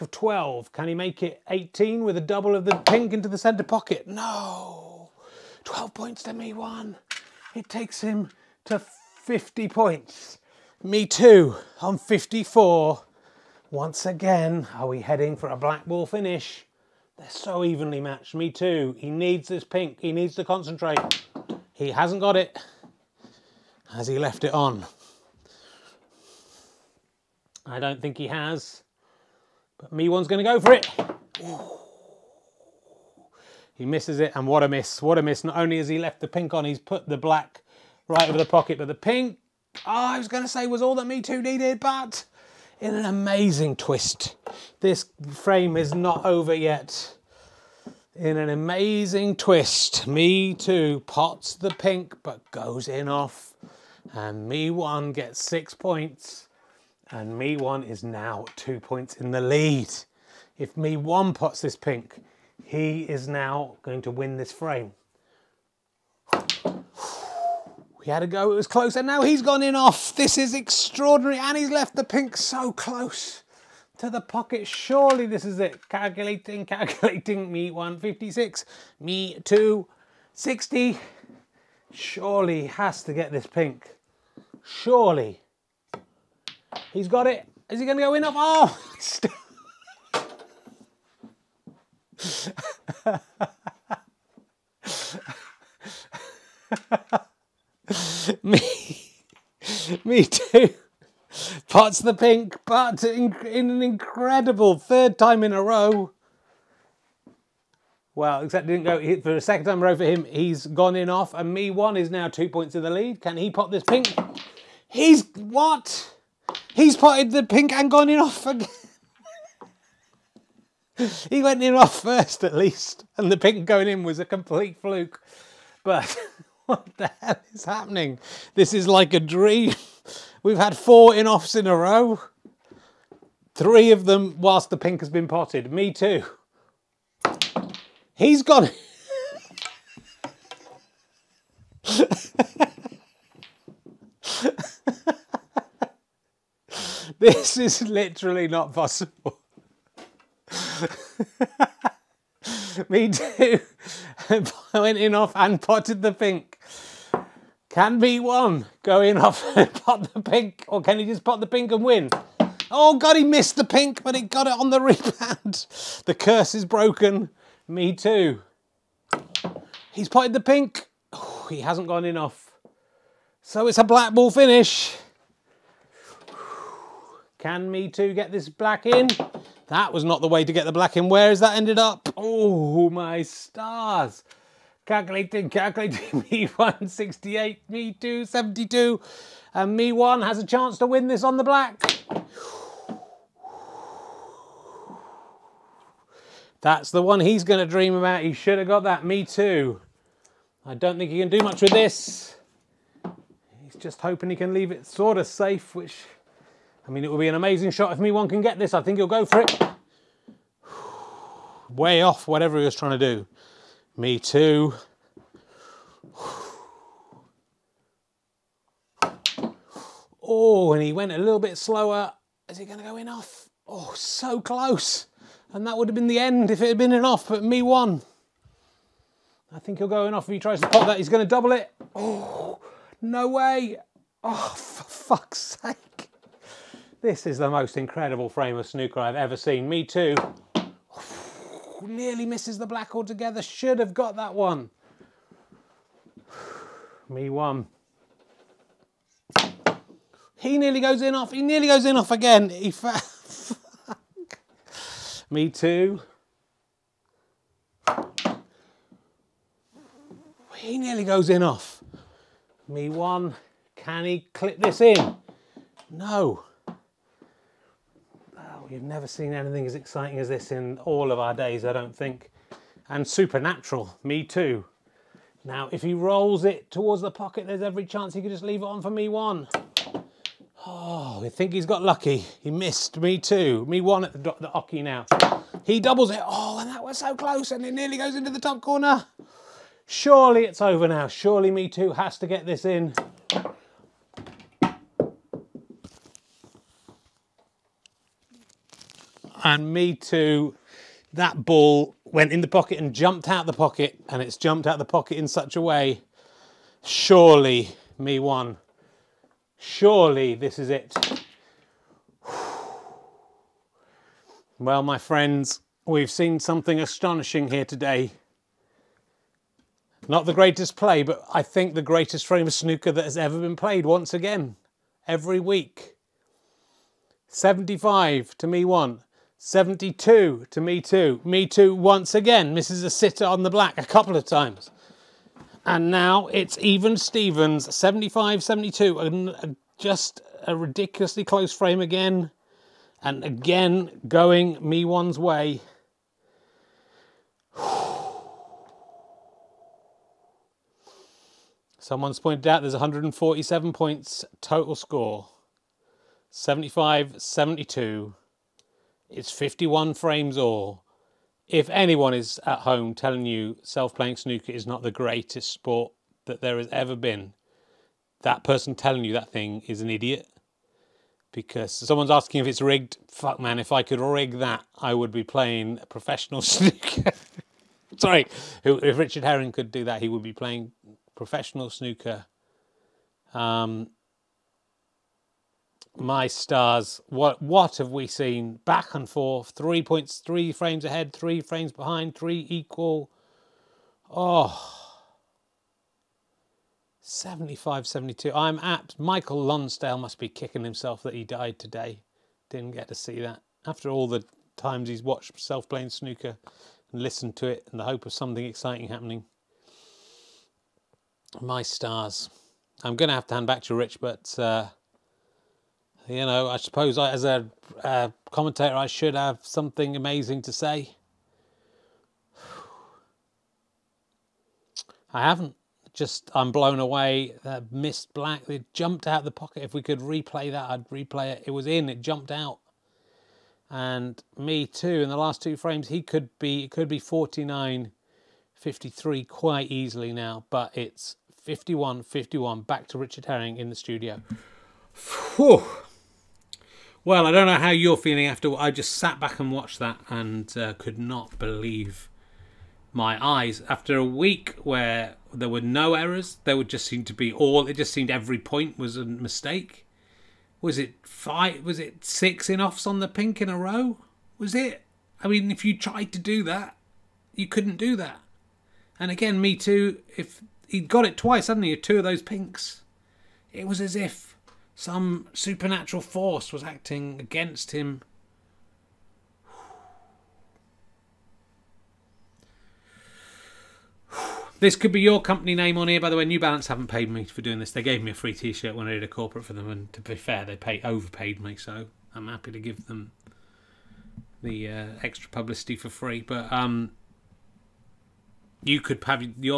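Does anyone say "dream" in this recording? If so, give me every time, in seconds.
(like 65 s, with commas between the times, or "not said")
129 s, 197 s.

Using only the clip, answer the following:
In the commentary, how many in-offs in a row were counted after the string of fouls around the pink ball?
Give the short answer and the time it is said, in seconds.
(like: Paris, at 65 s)
4, at 130 s.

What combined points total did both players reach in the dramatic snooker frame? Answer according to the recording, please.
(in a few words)
147.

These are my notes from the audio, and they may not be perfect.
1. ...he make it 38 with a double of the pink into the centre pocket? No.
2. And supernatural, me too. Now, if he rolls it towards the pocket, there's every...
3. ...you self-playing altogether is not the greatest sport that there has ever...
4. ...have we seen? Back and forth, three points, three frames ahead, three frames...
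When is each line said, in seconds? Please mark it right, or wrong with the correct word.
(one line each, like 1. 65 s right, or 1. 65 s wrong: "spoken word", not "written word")
1. 0 s wrong: "18", not "38"
2. 272 s right
3. 363 s wrong: "snooker", not "altogether"
4. 387 s right.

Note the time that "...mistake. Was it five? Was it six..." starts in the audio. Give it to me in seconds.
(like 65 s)
459 s.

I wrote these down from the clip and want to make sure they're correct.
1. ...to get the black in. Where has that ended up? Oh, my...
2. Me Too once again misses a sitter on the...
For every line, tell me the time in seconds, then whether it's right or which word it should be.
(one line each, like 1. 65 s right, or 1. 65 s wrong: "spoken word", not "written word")
1. 180 s right
2. 331 s right.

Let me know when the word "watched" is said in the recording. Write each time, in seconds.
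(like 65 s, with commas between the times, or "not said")
405 s, 449 s.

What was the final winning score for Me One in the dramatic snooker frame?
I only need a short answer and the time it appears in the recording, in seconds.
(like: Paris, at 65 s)
75, at 327 s.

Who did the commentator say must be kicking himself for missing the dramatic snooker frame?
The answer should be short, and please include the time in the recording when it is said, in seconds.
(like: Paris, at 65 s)
Michael Lonsdale, at 398 s.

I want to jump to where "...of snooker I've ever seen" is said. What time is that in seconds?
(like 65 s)
238 s.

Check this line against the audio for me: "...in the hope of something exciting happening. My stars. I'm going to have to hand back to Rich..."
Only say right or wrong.
right.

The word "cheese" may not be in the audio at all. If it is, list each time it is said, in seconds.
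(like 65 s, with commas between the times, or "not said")
not said.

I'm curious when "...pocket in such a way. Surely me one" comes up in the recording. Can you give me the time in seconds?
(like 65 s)
304 s.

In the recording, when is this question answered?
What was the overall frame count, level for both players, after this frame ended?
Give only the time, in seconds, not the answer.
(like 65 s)
359 s.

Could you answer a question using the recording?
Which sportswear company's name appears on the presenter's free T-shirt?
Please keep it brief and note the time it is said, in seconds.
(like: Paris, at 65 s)
New Balance, at 486 s.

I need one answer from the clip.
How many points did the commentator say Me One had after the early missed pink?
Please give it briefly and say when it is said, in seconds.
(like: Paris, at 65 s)
54, at 11 s.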